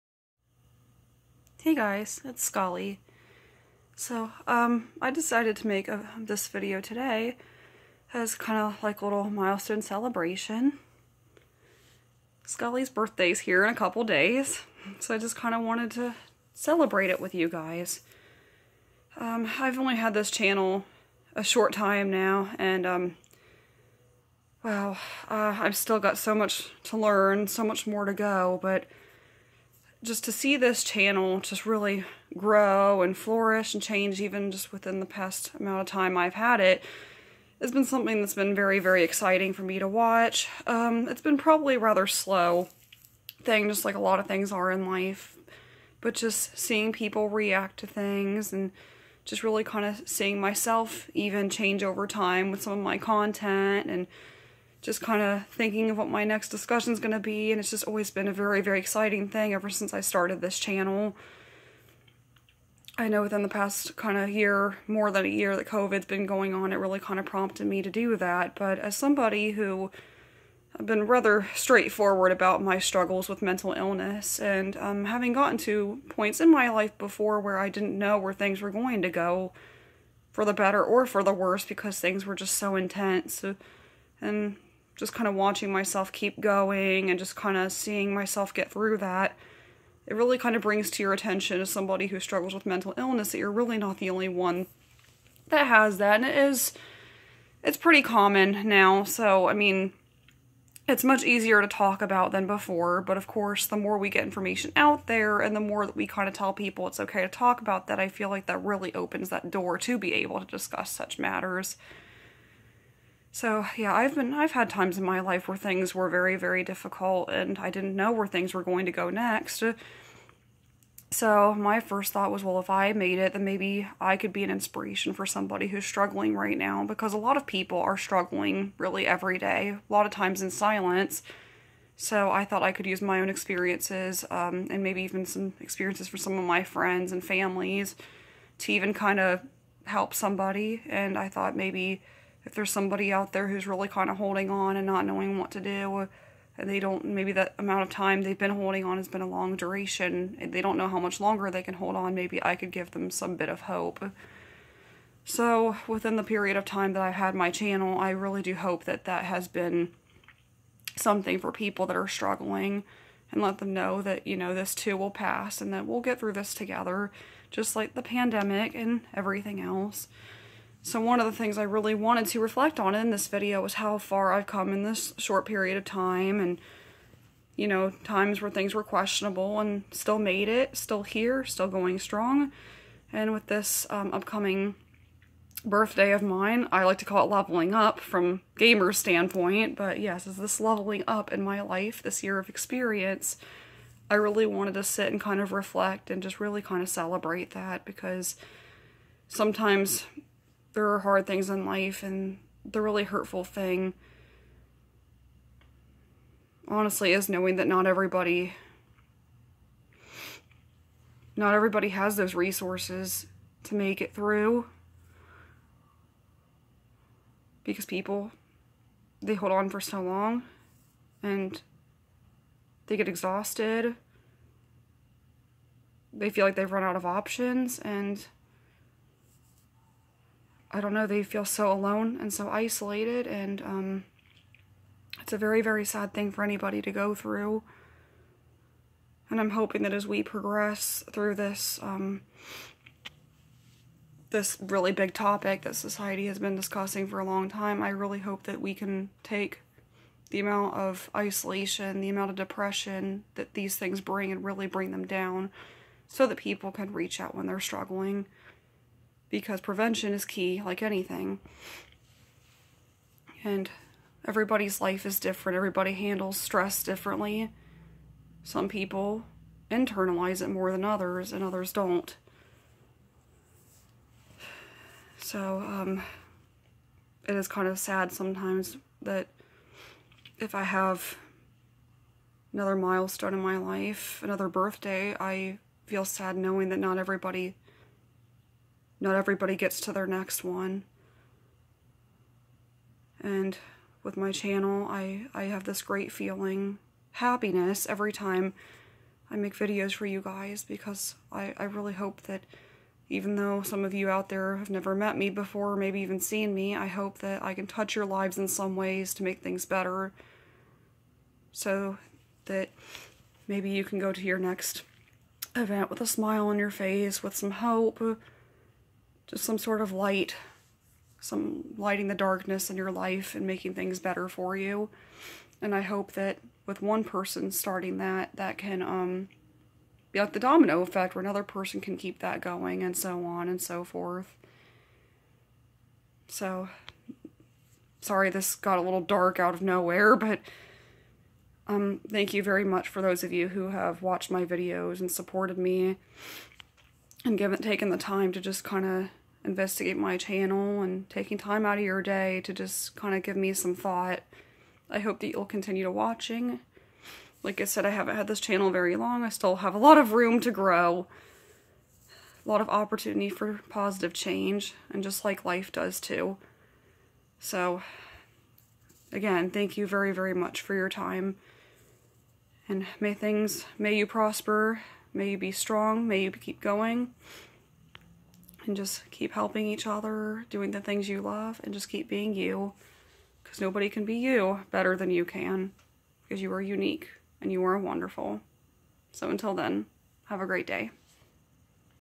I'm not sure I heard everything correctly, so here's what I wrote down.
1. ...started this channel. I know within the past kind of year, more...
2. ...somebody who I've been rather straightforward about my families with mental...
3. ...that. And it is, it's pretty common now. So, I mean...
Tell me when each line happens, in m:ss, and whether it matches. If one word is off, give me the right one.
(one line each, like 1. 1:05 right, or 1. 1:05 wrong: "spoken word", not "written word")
1. 1:00 right
2. 1:08 wrong: "struggles", not "families"
3. 1:35 right.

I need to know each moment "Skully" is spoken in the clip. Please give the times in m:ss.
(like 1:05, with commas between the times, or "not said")
0:02, 0:12.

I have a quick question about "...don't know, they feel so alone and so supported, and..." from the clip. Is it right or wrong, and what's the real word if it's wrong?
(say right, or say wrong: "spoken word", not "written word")
wrong: "isolated", not "supported".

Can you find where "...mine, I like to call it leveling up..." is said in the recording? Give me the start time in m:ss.
3:06.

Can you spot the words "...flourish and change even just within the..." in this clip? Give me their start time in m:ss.
0:33.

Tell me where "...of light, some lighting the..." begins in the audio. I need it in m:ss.
5:19.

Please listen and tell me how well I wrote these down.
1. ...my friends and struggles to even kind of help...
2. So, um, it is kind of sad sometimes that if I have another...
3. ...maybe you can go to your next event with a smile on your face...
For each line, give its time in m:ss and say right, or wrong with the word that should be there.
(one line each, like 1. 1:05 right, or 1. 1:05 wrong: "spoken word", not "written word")
1. 2:16 wrong: "families", not "struggles"
2. 4:35 right
3. 5:13 right.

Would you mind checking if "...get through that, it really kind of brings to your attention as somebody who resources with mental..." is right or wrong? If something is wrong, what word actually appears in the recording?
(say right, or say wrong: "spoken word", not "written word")
wrong: "struggles", not "resources".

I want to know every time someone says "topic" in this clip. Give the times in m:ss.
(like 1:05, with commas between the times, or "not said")
4:05.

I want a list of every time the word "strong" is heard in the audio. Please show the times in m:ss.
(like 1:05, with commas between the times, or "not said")
3:01, 6:15.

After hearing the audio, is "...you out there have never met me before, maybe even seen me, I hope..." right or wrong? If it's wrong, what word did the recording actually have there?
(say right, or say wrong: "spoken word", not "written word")
right.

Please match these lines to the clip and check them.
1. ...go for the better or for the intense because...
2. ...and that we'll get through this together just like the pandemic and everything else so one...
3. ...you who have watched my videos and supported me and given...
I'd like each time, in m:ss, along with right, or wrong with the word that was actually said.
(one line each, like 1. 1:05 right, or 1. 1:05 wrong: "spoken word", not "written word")
1. 1:19 wrong: "worse", not "intense"
2. 2:45 right
3. 5:43 right.